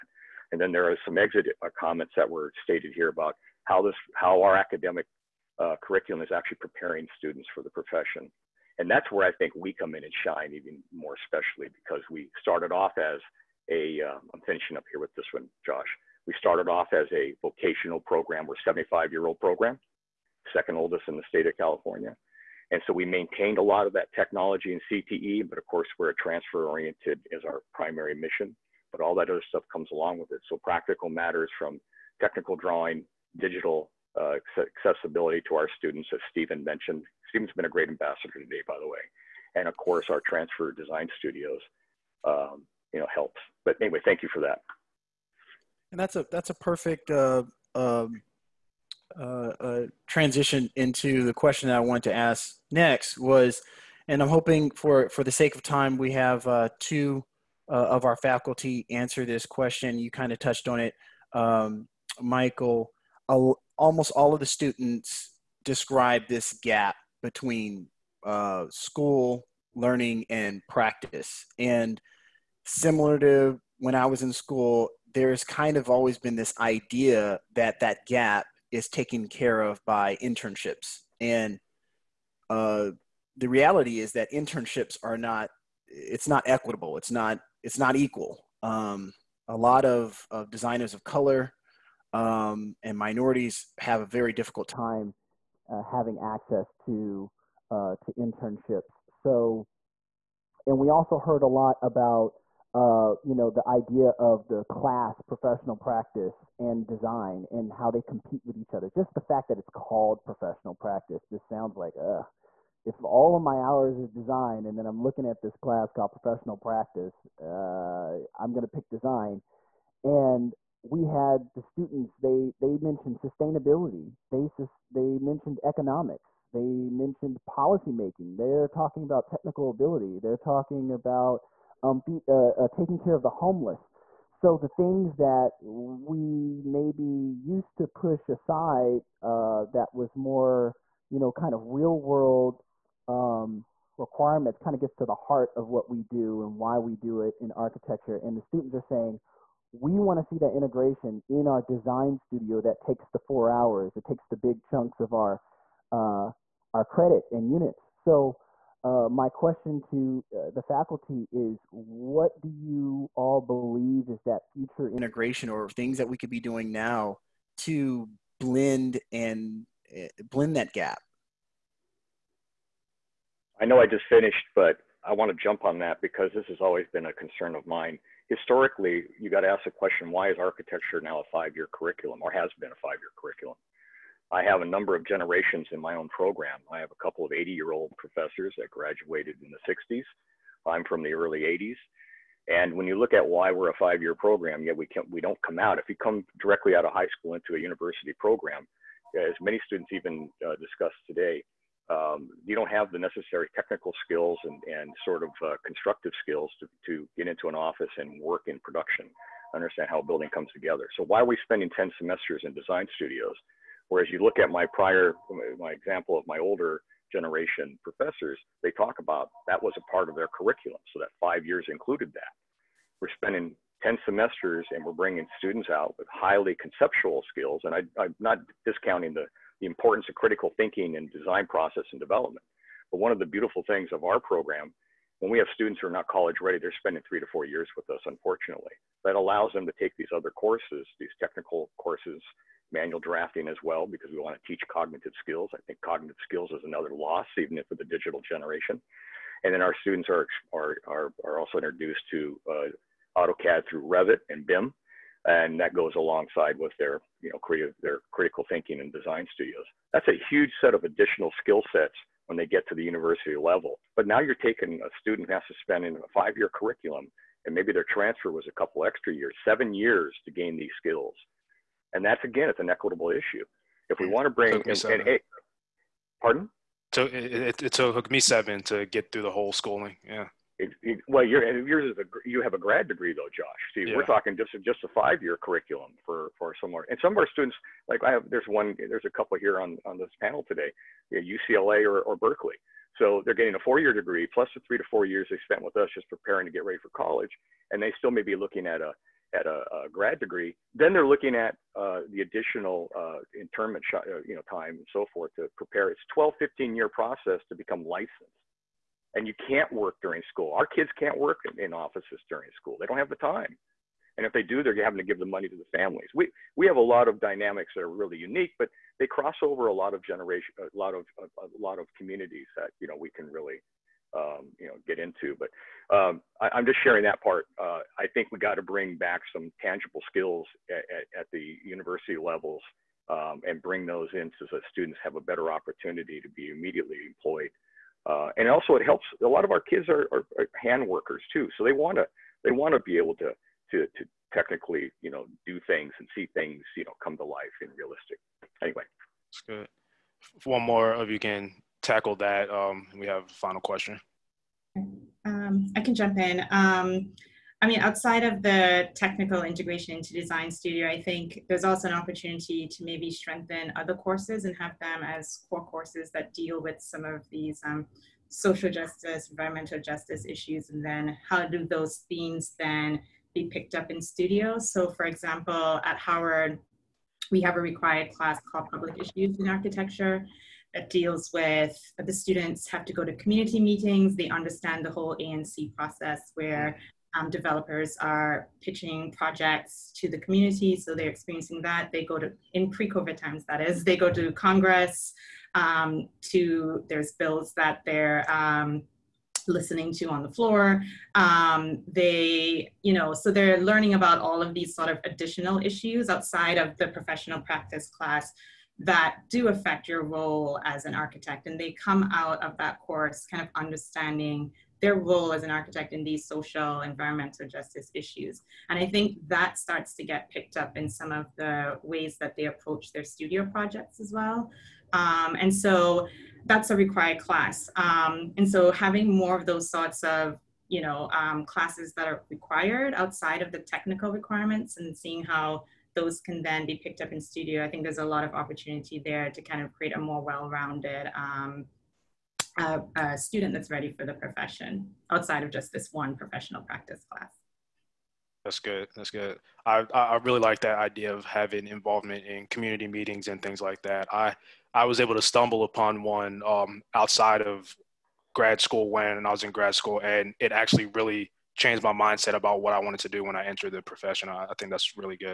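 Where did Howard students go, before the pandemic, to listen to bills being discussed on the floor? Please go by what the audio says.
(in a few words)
Congress.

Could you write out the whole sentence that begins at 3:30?
So why are we spending 10 semesters in design studios?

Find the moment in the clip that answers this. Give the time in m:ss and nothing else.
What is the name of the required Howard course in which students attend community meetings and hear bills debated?
6:18.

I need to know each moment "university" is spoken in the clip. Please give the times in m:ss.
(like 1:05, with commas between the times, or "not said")
3:17, 4:22, 5:31.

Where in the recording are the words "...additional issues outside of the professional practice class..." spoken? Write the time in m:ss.
6:45.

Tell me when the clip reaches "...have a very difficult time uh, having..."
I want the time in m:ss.
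1:33.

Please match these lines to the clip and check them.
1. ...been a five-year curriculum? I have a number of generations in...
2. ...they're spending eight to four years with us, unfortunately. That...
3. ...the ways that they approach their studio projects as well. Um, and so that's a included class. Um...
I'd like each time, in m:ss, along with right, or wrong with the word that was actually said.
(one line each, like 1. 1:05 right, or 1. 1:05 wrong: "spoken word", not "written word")
1. 3:02 right
2. 3:56 wrong: "three", not "eight"
3. 7:01 wrong: "required", not "included".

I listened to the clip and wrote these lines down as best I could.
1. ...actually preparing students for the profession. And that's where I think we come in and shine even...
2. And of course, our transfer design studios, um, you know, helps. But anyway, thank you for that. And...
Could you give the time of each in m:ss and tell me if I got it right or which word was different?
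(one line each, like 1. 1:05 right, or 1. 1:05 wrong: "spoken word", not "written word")
1. 0:06 right
2. 0:39 right.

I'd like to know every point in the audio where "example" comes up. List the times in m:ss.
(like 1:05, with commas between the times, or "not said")
3:35, 6:15.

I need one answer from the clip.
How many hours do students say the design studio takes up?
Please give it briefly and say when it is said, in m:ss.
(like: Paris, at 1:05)
4, at 2:33.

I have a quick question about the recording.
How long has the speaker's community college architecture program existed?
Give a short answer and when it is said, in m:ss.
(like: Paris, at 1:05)
75 years, at 0:18.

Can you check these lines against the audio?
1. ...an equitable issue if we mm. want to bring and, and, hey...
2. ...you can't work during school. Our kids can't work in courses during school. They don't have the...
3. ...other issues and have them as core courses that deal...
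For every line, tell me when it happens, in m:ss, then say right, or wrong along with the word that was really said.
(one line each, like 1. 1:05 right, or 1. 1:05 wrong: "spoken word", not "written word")
1. 4:32 right
2. 5:09 wrong: "offices", not "courses"
3. 6:03 wrong: "courses", not "issues".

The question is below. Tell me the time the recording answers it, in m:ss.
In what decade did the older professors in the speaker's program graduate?
3:09.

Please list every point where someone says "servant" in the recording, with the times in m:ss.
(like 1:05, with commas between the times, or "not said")
not said.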